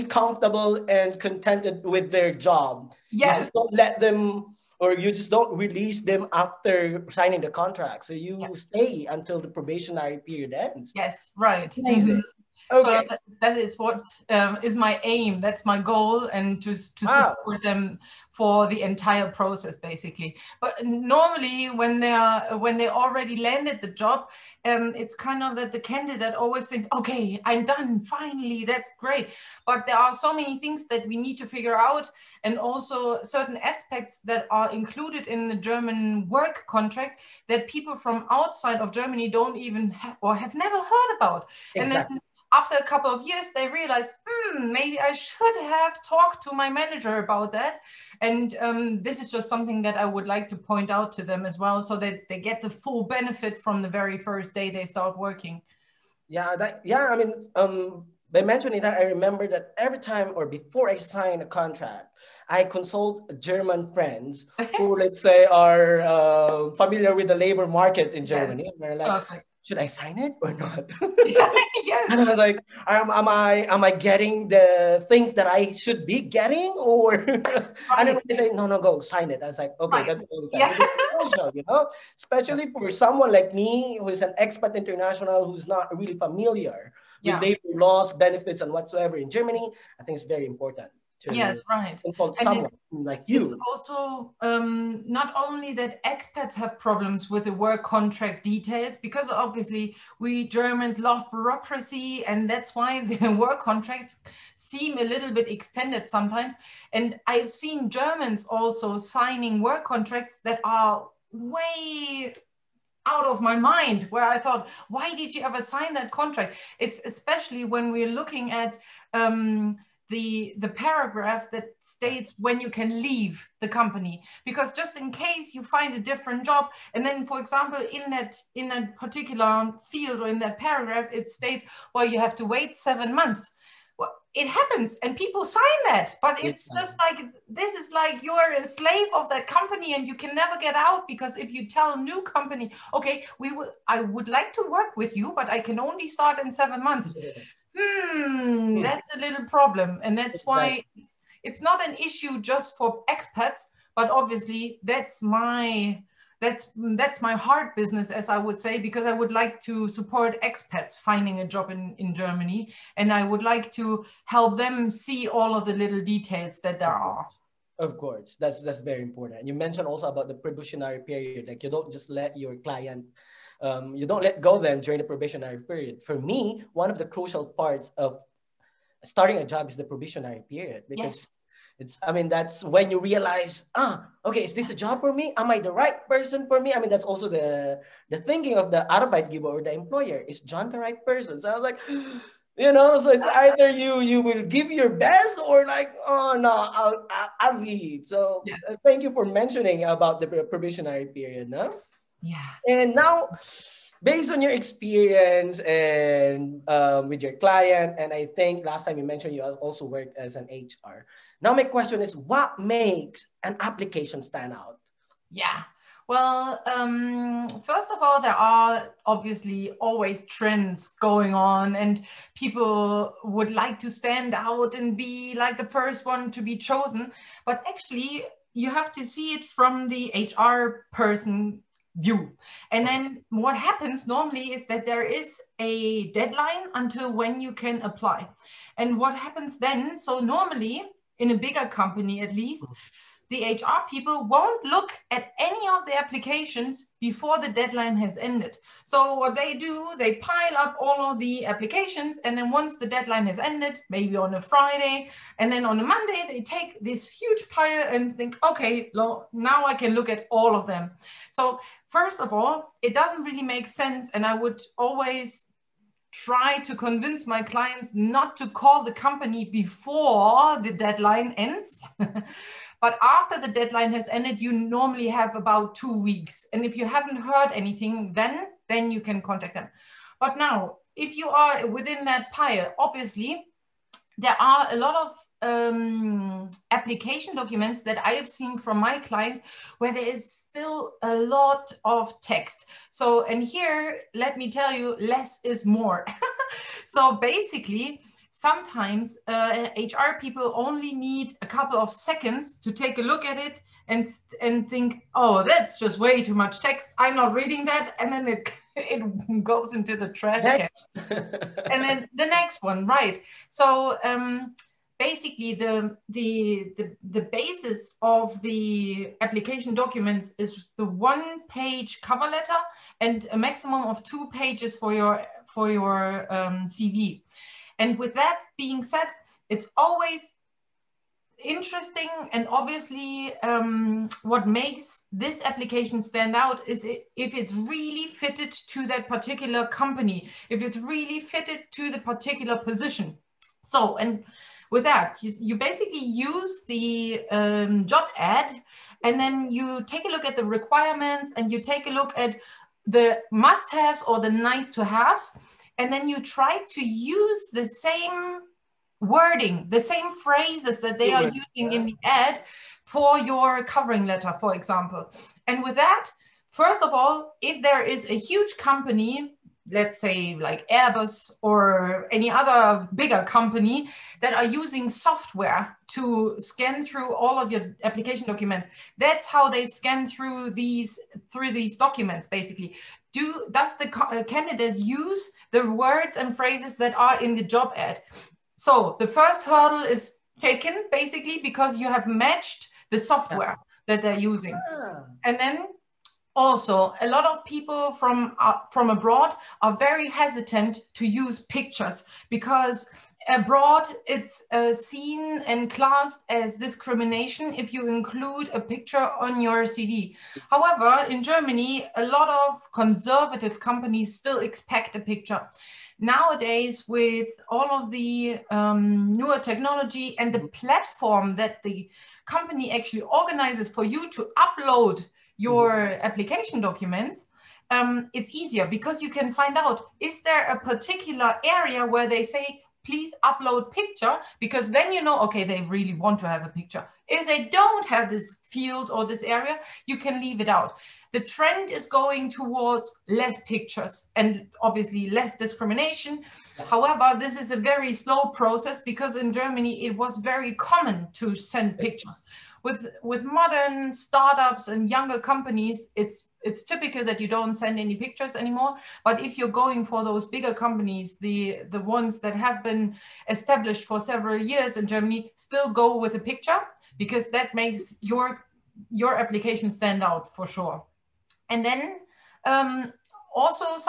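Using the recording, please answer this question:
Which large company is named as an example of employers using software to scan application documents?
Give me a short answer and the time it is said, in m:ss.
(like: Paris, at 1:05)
Airbus, at 6:10.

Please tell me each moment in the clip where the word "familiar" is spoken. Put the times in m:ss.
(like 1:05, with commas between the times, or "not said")
1:06, 1:26.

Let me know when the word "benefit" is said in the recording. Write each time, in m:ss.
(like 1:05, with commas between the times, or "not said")
0:53, 1:28.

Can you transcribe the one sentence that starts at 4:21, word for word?
So first of all, it doesn't really make sense.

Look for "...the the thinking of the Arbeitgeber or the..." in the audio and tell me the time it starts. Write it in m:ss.
3:07.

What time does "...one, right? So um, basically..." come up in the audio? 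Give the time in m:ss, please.
5:12.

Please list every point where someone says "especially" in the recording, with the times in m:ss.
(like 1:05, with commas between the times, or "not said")
1:22, 1:57.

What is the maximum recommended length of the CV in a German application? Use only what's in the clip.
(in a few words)
2 pages.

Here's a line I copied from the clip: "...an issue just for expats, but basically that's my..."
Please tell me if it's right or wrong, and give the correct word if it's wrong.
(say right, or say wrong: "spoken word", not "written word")
wrong: "obviously", not "basically".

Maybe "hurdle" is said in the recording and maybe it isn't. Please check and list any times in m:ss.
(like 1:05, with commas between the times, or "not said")
6:29.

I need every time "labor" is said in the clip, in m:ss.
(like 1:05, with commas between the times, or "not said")
1:07, 1:27.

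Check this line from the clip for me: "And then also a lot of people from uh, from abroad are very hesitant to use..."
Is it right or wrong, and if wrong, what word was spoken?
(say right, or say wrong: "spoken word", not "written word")
right.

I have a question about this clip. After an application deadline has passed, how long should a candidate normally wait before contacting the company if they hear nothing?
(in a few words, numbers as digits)
2 weeks.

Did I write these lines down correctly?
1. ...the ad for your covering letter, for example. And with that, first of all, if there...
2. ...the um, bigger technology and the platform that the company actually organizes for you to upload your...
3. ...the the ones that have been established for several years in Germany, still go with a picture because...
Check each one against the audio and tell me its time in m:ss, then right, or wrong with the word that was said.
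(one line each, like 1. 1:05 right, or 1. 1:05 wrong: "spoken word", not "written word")
1. 6:01 right
2. 6:57 wrong: "newer", not "bigger"
3. 7:41 right.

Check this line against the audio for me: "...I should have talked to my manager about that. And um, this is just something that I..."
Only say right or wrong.
right.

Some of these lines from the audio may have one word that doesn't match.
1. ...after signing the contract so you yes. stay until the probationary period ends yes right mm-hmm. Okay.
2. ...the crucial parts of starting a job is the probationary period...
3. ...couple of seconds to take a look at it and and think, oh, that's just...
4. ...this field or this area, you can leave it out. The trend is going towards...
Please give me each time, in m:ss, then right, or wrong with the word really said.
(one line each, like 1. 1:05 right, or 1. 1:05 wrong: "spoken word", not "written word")
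1. 0:06 right
2. 2:56 right
3. 5:01 right
4. 7:18 right.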